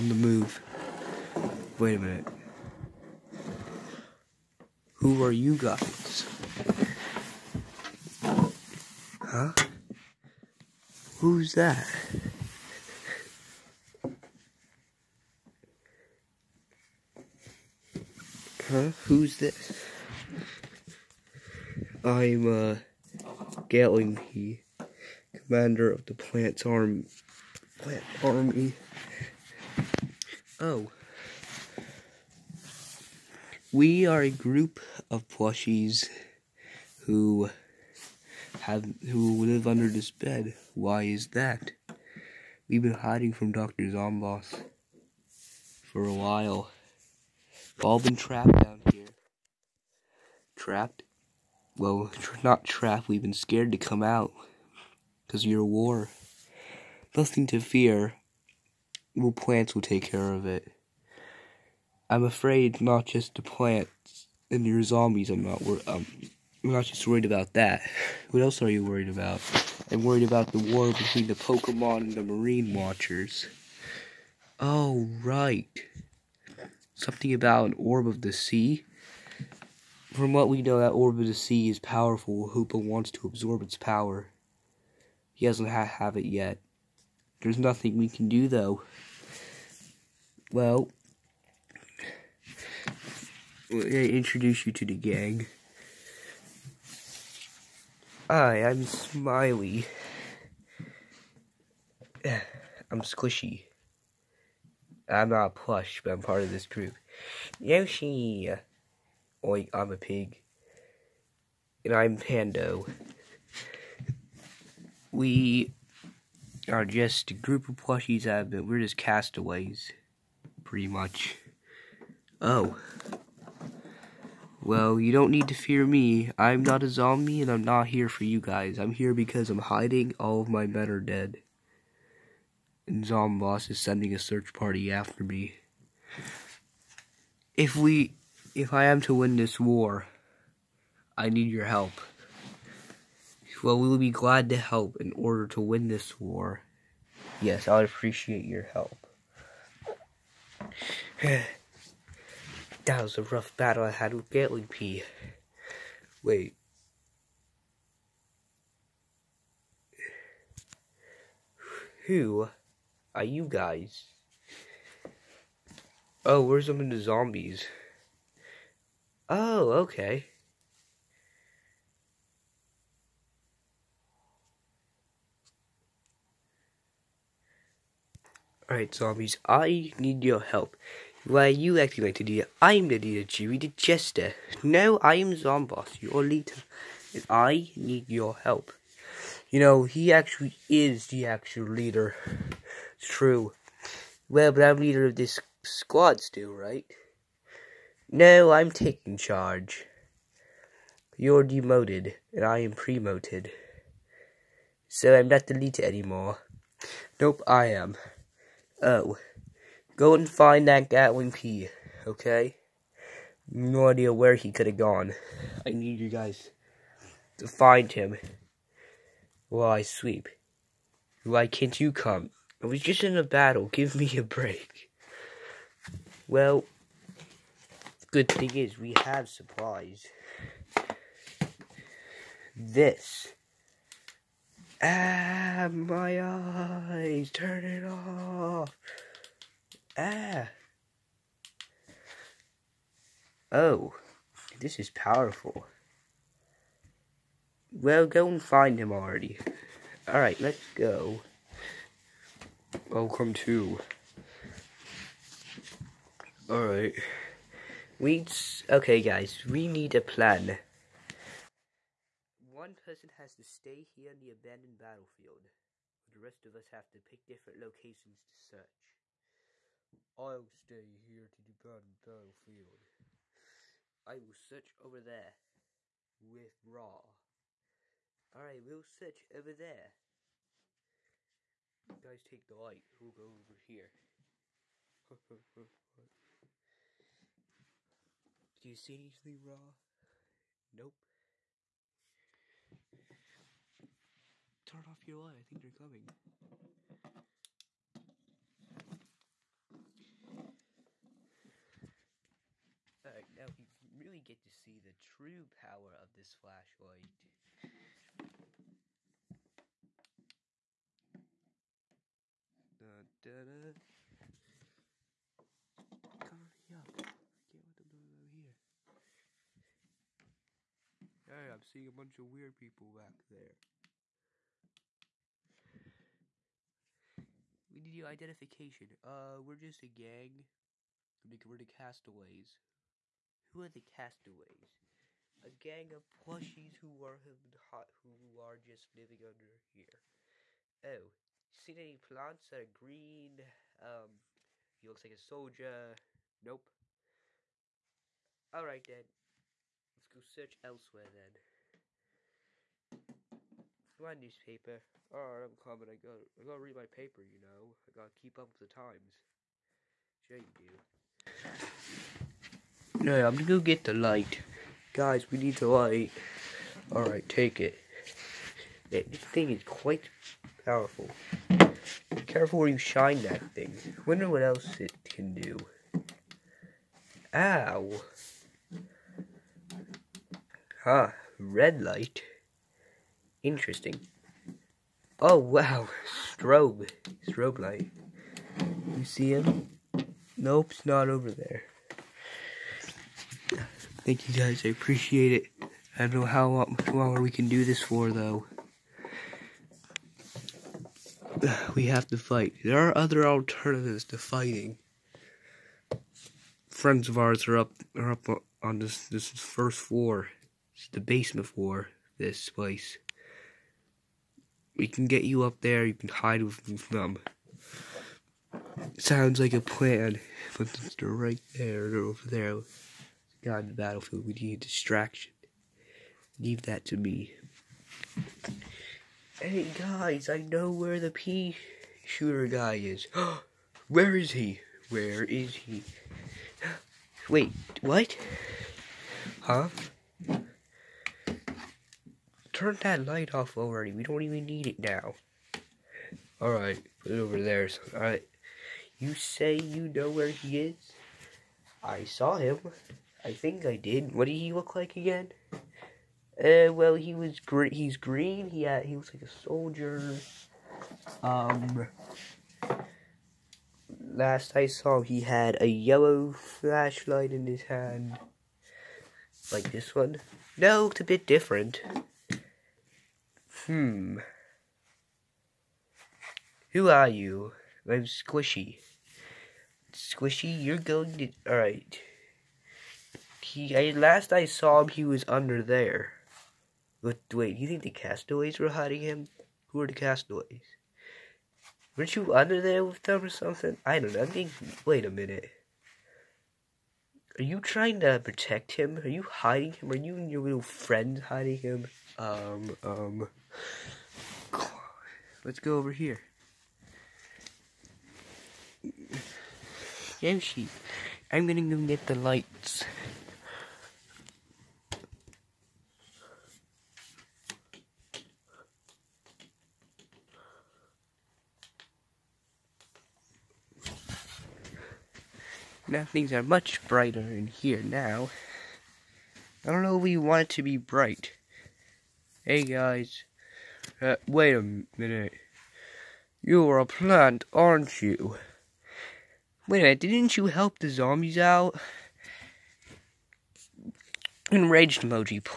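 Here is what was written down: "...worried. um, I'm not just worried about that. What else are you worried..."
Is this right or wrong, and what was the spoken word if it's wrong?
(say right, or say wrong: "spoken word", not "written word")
right.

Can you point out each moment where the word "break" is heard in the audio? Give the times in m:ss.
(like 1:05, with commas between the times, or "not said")
3:44.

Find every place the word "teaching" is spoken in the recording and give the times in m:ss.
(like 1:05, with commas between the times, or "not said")
not said.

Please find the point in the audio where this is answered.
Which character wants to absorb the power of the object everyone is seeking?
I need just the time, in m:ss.
1:22.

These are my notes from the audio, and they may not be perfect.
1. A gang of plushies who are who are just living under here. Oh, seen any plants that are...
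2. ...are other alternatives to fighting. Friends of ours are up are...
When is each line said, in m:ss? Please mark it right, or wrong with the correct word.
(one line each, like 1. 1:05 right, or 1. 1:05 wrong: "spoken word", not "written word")
1. 5:35 right
2. 6:42 right.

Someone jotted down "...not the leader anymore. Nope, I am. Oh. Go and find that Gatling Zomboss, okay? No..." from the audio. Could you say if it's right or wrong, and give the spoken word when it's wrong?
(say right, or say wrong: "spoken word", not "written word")
wrong: "Pea", not "Zomboss".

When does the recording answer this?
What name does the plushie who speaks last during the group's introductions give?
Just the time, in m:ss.
1:52.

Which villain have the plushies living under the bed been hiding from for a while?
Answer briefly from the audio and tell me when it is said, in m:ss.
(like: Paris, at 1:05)
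Dr. Zomboss, at 0:43.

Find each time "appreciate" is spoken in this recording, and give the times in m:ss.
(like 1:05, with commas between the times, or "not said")
2:27, 6:34.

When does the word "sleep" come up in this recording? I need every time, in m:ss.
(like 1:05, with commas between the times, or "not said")
3:39.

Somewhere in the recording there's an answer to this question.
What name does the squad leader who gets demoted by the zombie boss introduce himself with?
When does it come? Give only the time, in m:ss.
3:03.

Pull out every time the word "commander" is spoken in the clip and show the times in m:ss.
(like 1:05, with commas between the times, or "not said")
0:25.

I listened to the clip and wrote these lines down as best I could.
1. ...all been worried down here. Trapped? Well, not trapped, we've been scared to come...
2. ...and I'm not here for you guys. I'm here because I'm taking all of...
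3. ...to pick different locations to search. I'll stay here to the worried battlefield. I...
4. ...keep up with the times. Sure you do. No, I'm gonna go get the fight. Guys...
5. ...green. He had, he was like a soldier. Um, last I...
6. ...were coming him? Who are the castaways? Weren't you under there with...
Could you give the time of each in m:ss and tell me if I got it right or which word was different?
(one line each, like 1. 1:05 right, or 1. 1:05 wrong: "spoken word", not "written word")
1. 0:47 wrong: "trapped", not "worried"
2. 2:07 wrong: "hiding", not "taking"
3. 4:26 wrong: "abandoned", not "worried"
4. 5:58 wrong: "light", not "fight"
5. 7:37 right
6. 8:08 wrong: "hiding", not "coming".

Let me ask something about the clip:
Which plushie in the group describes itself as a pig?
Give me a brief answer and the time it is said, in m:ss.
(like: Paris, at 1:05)
Oink, at 1:49.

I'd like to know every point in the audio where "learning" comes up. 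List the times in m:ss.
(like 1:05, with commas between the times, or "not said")
not said.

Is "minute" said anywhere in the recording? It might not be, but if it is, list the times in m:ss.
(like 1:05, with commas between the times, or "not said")
0:01, 8:15, 8:54, 8:59.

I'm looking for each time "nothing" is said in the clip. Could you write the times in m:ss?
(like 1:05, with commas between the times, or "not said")
0:57, 1:27.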